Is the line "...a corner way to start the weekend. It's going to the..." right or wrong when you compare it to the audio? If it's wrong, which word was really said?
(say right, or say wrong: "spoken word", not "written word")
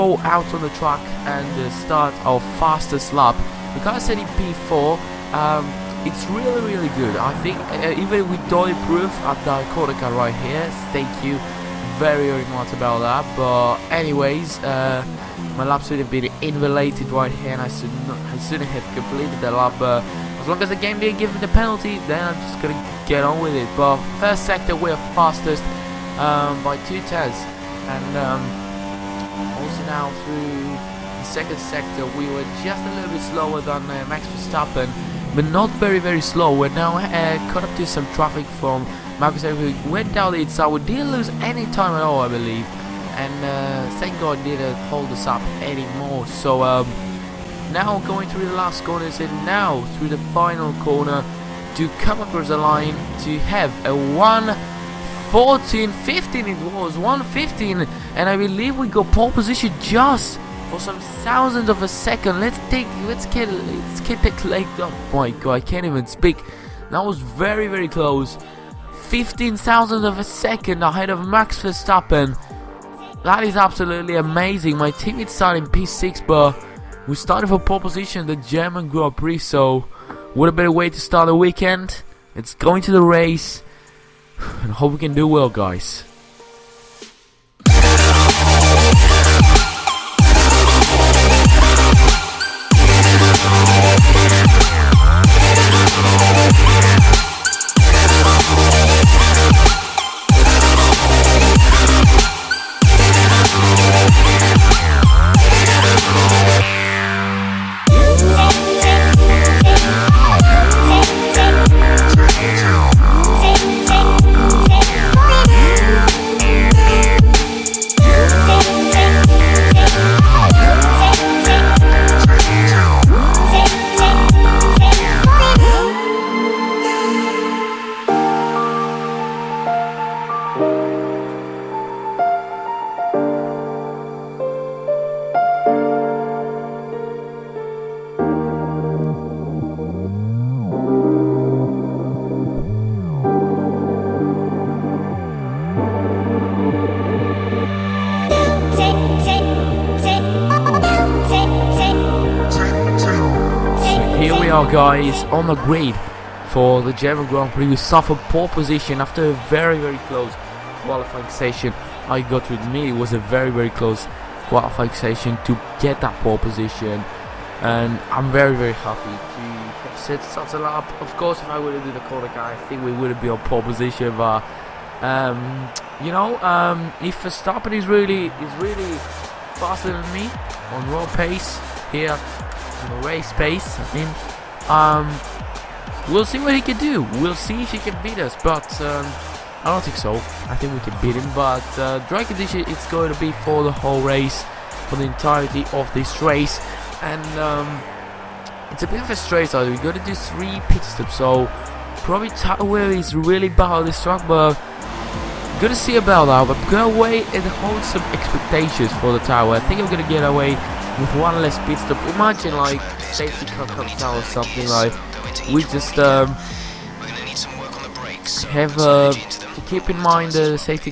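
wrong: "better", not "corner".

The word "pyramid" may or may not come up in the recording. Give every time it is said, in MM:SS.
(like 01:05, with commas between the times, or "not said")
not said.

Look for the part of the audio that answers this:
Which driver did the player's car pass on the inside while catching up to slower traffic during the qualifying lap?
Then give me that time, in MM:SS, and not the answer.
00:39.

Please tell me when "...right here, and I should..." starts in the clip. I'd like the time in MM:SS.
00:17.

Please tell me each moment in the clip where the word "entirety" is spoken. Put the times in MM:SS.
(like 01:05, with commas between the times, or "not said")
03:15.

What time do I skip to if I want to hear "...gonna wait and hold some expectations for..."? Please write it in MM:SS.
03:26.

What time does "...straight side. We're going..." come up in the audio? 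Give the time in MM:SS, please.
03:19.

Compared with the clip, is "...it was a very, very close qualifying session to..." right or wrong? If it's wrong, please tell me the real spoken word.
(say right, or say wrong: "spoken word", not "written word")
right.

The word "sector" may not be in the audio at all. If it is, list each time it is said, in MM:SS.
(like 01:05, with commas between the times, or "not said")
00:24, 00:31.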